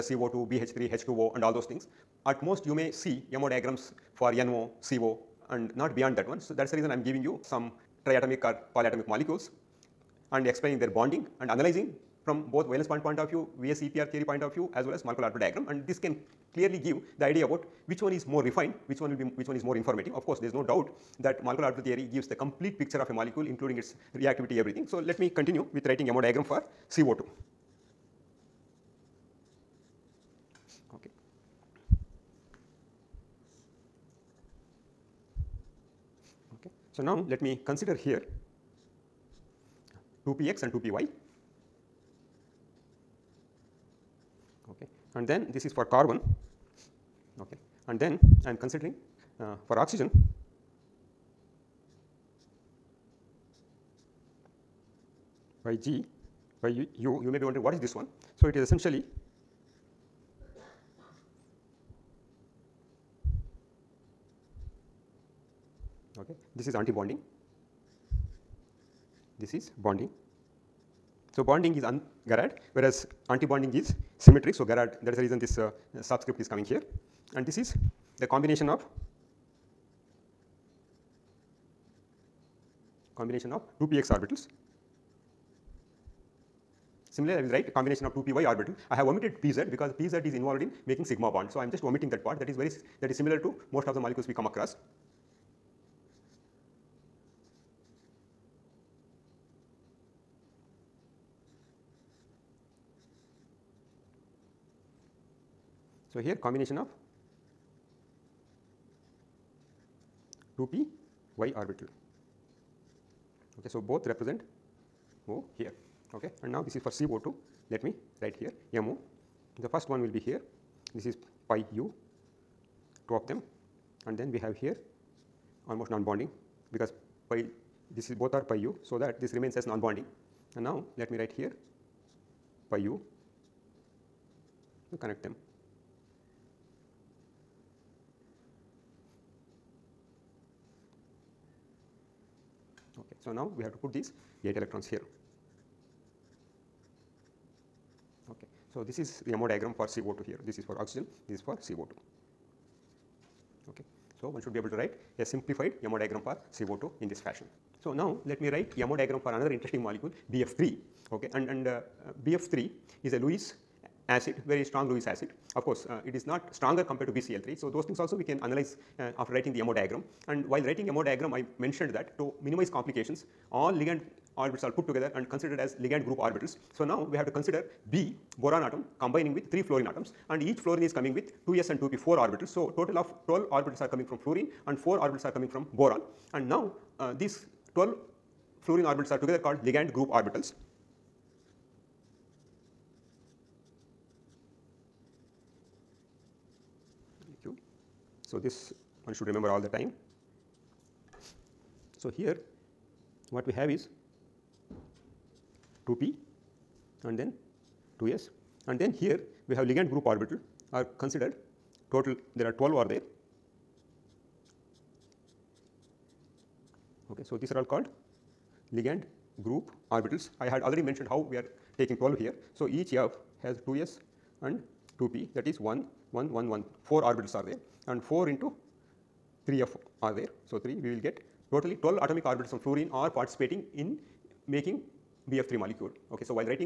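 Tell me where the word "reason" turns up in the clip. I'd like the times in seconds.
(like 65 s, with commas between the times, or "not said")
6 s, 75 s.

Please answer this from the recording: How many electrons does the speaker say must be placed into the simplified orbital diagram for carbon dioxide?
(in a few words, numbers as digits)
8.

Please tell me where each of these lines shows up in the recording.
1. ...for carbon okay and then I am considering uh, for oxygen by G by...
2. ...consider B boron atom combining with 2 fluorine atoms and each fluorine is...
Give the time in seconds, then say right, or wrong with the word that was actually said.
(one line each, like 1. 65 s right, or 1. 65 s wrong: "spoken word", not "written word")
1. 45 s right
2. 177 s wrong: "3", not "2".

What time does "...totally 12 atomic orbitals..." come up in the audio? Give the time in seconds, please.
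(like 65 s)
231 s.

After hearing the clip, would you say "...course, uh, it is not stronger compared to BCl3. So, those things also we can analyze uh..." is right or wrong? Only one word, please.
right.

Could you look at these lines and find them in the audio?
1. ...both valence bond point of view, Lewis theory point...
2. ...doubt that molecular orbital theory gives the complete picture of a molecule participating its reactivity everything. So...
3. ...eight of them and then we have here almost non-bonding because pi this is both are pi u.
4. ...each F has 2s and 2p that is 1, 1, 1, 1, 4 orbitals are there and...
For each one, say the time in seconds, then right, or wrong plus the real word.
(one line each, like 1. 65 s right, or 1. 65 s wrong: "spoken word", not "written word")
1. 12 s wrong: "VSEPR", not "Lewis"
2. 20 s wrong: "including", not "participating"
3. 123 s wrong: "two", not "eight"
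4. 222 s right.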